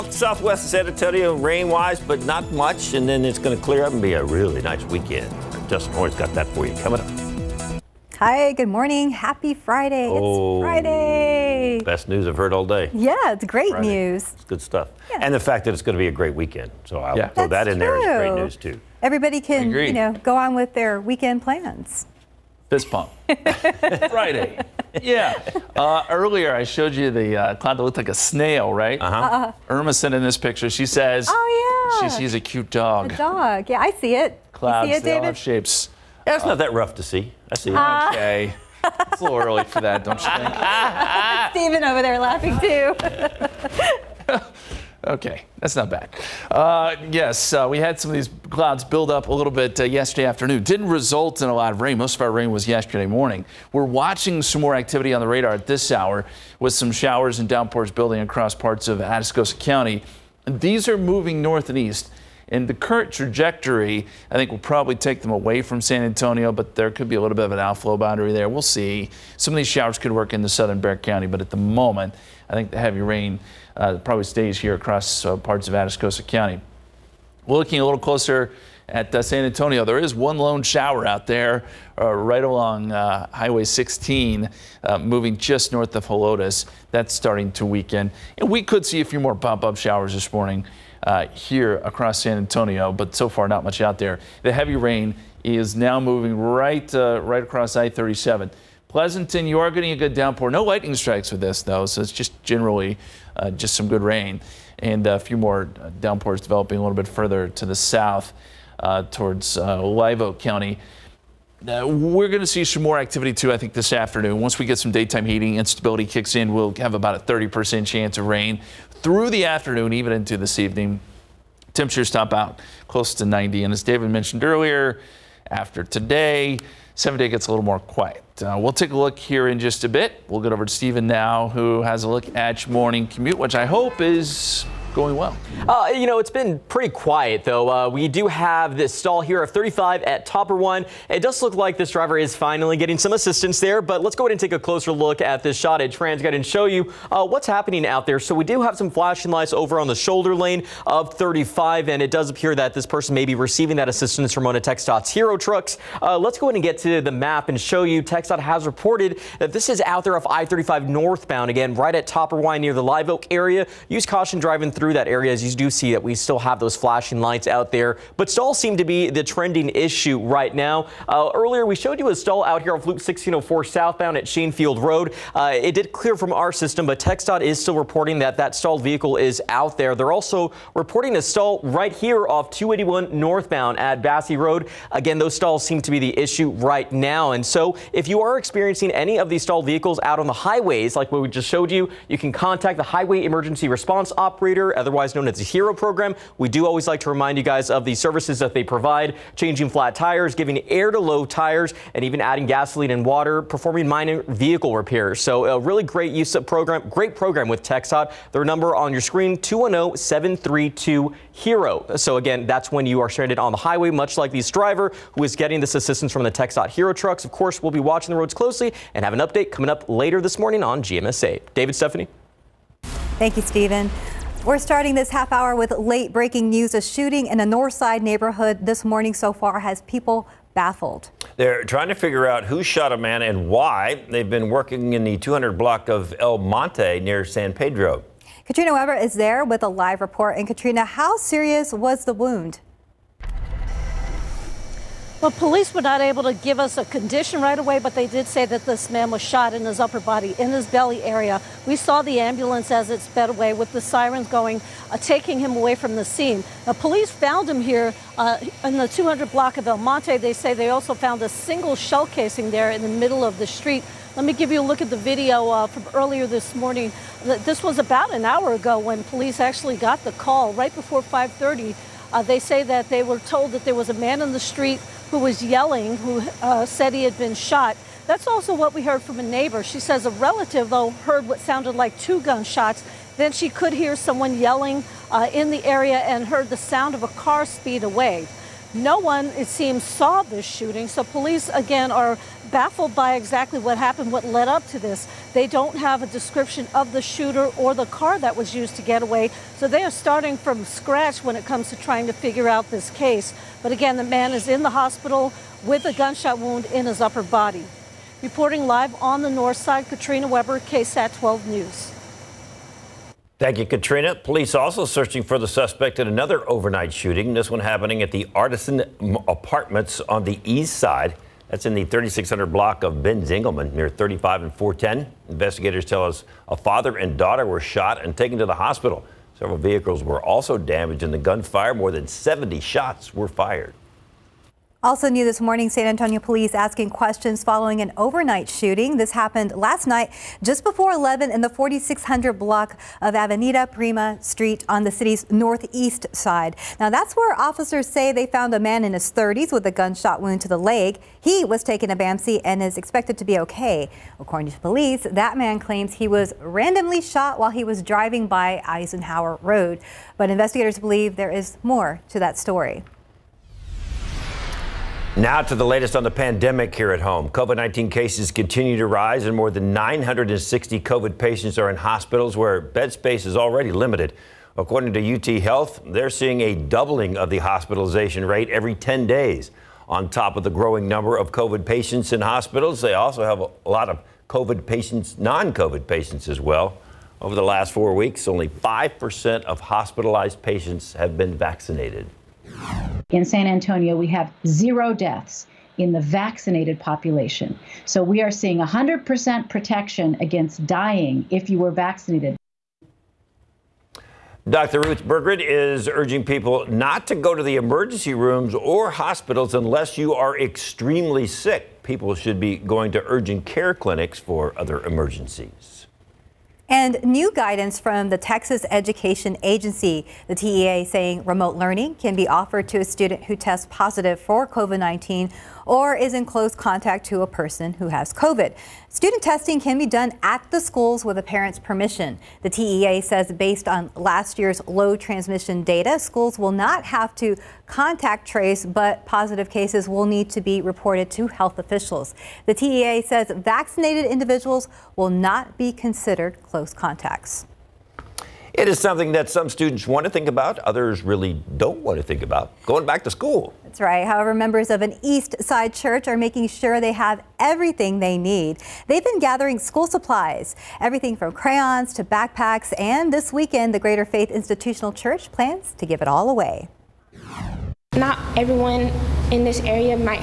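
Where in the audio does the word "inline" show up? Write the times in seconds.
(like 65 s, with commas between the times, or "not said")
not said.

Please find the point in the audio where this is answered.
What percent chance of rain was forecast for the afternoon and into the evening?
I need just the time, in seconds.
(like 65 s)
117 s.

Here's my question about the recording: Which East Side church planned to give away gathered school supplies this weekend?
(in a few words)
Greater Faith Institutional Church.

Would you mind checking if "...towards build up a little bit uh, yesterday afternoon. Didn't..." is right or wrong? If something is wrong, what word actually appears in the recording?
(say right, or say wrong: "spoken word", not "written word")
wrong: "clouds", not "towards".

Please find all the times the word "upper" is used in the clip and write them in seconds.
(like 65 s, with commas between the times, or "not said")
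249 s, 306 s.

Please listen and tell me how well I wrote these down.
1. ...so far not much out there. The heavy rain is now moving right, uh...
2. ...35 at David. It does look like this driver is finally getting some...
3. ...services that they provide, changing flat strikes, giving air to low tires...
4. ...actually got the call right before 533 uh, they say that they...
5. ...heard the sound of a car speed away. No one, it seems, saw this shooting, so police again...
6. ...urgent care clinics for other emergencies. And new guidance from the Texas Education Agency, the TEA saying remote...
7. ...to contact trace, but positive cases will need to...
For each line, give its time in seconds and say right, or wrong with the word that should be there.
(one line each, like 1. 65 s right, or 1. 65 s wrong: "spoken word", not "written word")
1. 93 s right
2. 139 s wrong: "Topperwein", not "David"
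3. 197 s wrong: "tires", not "strikes"
4. 269 s wrong: "530", not "533"
5. 286 s right
6. 413 s right
7. 437 s right.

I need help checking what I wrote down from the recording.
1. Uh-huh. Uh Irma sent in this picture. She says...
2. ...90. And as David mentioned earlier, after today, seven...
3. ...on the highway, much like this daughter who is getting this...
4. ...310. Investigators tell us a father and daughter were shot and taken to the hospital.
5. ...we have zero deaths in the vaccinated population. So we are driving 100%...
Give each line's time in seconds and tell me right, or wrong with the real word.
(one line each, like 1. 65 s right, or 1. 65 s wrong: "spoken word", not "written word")
1. 28 s right
2. 123 s right
3. 213 s wrong: "driver", not "daughter"
4. 324 s wrong: "410", not "310"
5. 393 s wrong: "seeing", not "driving".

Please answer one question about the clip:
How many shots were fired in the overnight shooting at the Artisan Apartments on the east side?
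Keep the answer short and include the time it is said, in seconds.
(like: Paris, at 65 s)
More than 70, at 331 s.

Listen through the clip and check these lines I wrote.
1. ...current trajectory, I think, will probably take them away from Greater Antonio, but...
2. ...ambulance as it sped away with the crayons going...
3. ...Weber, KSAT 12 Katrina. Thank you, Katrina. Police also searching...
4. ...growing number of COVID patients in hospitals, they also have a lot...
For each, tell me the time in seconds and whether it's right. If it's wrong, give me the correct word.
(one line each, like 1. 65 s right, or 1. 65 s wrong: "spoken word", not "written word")
1. 62 s wrong: "San", not "Greater"
2. 252 s wrong: "sirens", not "crayons"
3. 310 s wrong: "News", not "Katrina"
4. 380 s right.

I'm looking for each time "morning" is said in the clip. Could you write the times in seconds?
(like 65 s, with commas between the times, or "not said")
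8 s, 53 s, 90 s, 132 s, 220 s, 228 s, 266 s, 335 s.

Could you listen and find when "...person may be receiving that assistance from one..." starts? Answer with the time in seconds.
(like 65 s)
152 s.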